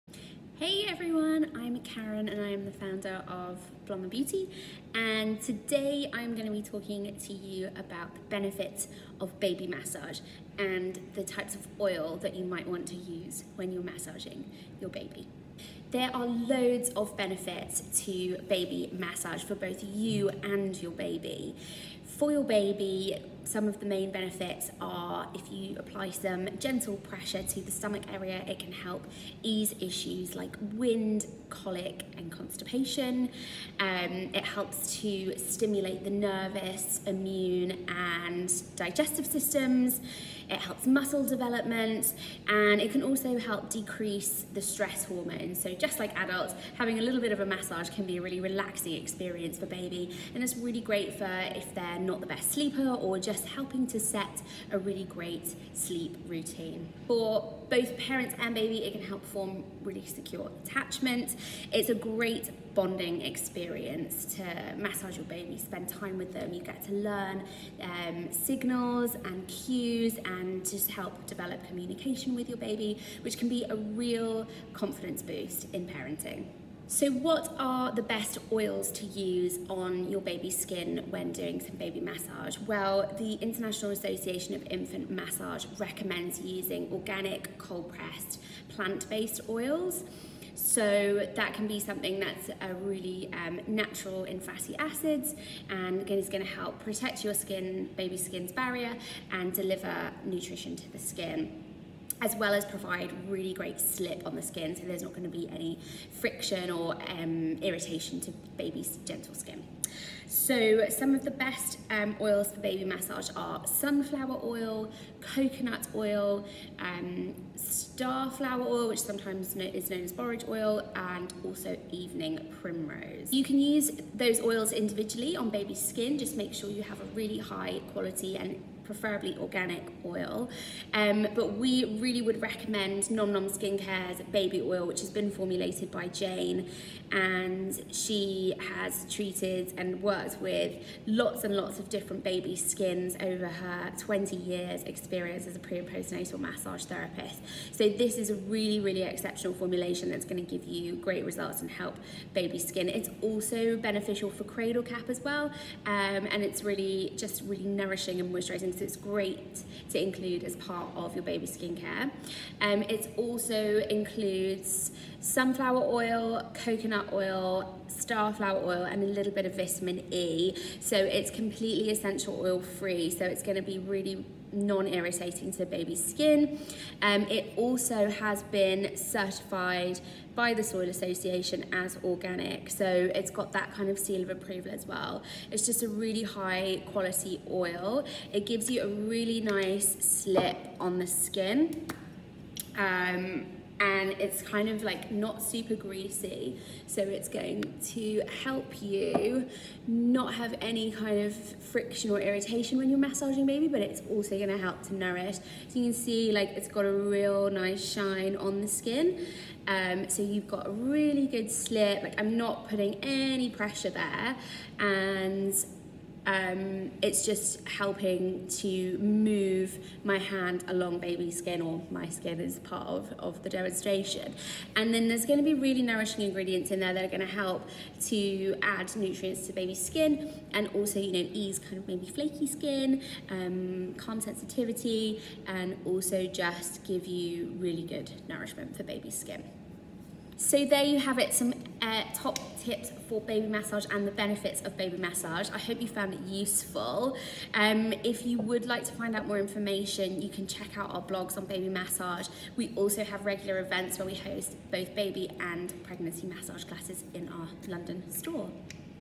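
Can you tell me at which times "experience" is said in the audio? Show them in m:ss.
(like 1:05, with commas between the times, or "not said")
0:49, 1:03, 2:24.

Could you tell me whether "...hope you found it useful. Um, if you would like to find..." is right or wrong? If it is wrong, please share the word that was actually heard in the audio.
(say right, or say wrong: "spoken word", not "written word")
right.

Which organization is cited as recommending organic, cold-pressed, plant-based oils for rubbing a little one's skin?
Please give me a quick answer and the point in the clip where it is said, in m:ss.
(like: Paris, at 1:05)
International Association of Infant Massage, at 1:23.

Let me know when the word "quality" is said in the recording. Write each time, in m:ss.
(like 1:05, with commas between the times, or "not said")
2:07, 3:06.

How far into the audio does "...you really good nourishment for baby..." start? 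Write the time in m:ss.
3:57.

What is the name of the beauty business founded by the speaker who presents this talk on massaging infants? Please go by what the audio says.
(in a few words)
Blomma Beauty.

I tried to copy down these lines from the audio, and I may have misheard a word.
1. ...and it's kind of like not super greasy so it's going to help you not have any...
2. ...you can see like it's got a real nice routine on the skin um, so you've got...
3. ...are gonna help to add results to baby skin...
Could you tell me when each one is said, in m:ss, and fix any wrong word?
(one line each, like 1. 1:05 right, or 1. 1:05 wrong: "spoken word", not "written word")
1. 3:13 right
2. 3:25 wrong: "shine", not "routine"
3. 3:47 wrong: "nutrients", not "results".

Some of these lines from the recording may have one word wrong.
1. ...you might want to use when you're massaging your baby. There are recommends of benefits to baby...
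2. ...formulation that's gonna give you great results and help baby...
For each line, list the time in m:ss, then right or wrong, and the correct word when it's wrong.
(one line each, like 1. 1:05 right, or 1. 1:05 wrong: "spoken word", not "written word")
1. 0:12 wrong: "loads", not "recommends"
2. 2:29 right.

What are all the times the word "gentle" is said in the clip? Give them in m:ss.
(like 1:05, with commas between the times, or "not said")
0:26, 1:49.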